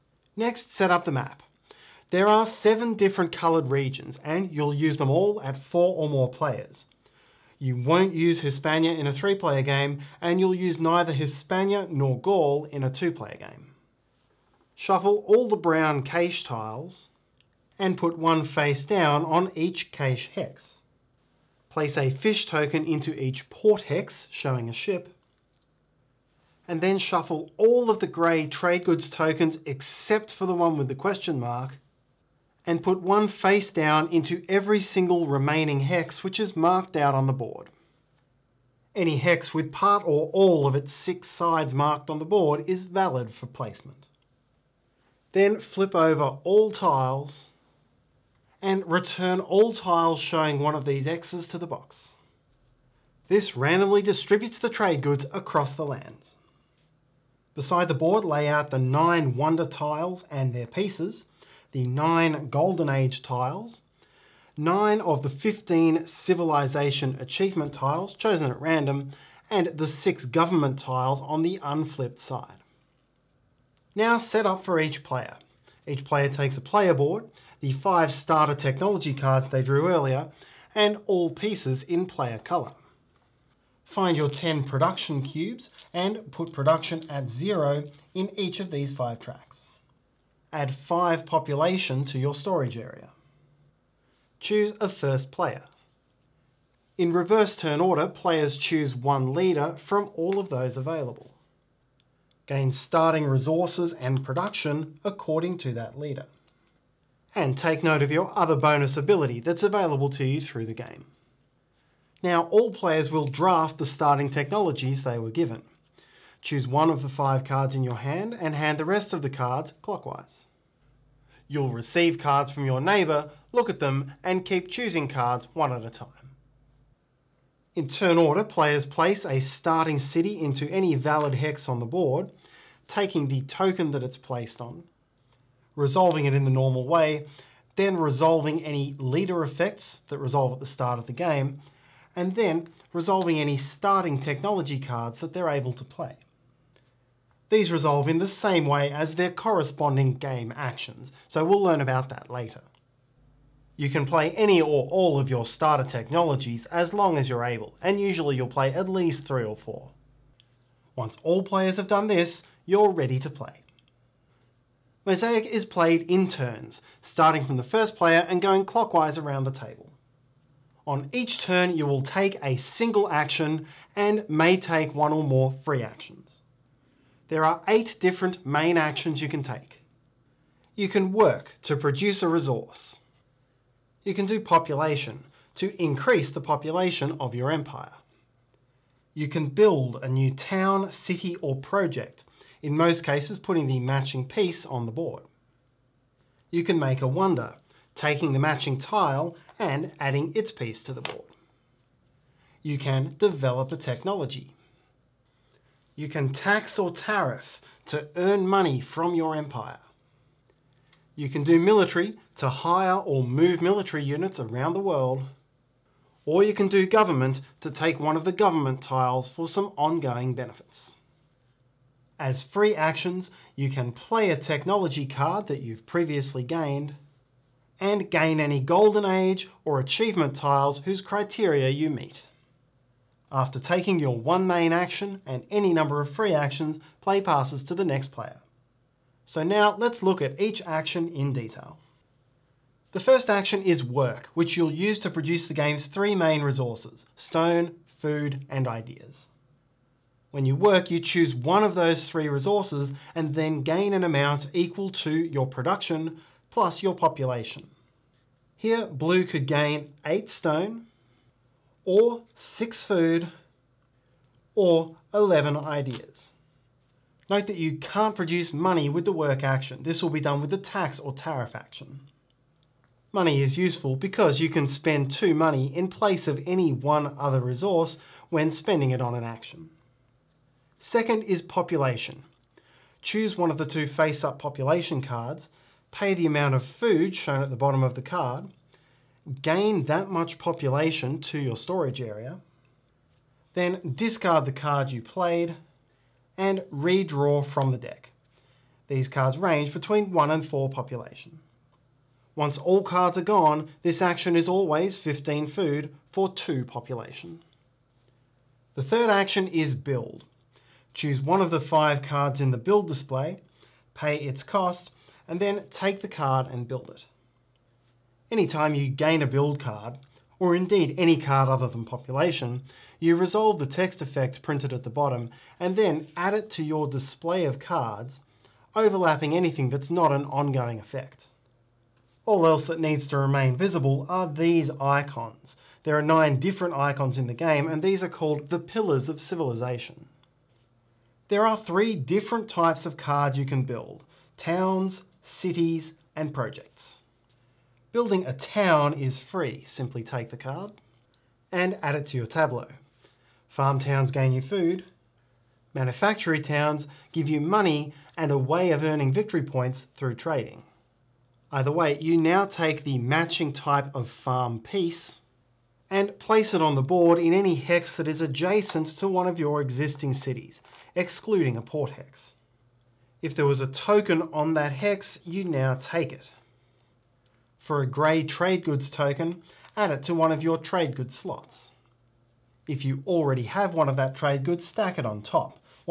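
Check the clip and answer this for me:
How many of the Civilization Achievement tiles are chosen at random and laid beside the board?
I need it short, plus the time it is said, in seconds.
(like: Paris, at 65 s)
9, at 64 s.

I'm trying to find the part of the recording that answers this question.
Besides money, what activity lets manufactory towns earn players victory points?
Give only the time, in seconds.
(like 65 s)
360 s.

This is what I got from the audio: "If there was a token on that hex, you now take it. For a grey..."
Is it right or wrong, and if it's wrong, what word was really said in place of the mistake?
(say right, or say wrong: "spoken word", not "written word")
right.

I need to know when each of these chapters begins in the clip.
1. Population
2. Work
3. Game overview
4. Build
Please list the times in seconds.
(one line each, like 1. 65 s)
1. 279 s
2. 241 s
3. 163 s
4. 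307 s.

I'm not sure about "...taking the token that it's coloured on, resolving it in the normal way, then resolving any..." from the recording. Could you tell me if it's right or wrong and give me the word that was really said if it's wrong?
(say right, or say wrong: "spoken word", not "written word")
wrong: "placed", not "coloured".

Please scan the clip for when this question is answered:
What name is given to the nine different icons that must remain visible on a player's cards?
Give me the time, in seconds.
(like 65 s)
338 s.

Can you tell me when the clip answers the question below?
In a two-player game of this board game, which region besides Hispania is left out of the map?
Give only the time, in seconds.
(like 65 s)
12 s.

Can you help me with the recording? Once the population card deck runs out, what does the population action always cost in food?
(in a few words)
15 food.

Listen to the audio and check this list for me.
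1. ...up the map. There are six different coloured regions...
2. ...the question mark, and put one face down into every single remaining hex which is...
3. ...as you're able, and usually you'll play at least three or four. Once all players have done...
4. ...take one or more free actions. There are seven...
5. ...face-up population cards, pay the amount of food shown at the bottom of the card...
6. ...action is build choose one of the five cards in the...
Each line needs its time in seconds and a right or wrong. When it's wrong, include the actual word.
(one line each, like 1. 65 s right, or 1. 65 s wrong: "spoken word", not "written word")
1. 0 s wrong: "seven", not "six"
2. 30 s right
3. 157 s right
4. 174 s wrong: "eight", not "seven"
5. 283 s right
6. 309 s right.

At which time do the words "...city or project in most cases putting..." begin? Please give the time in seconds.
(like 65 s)
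190 s.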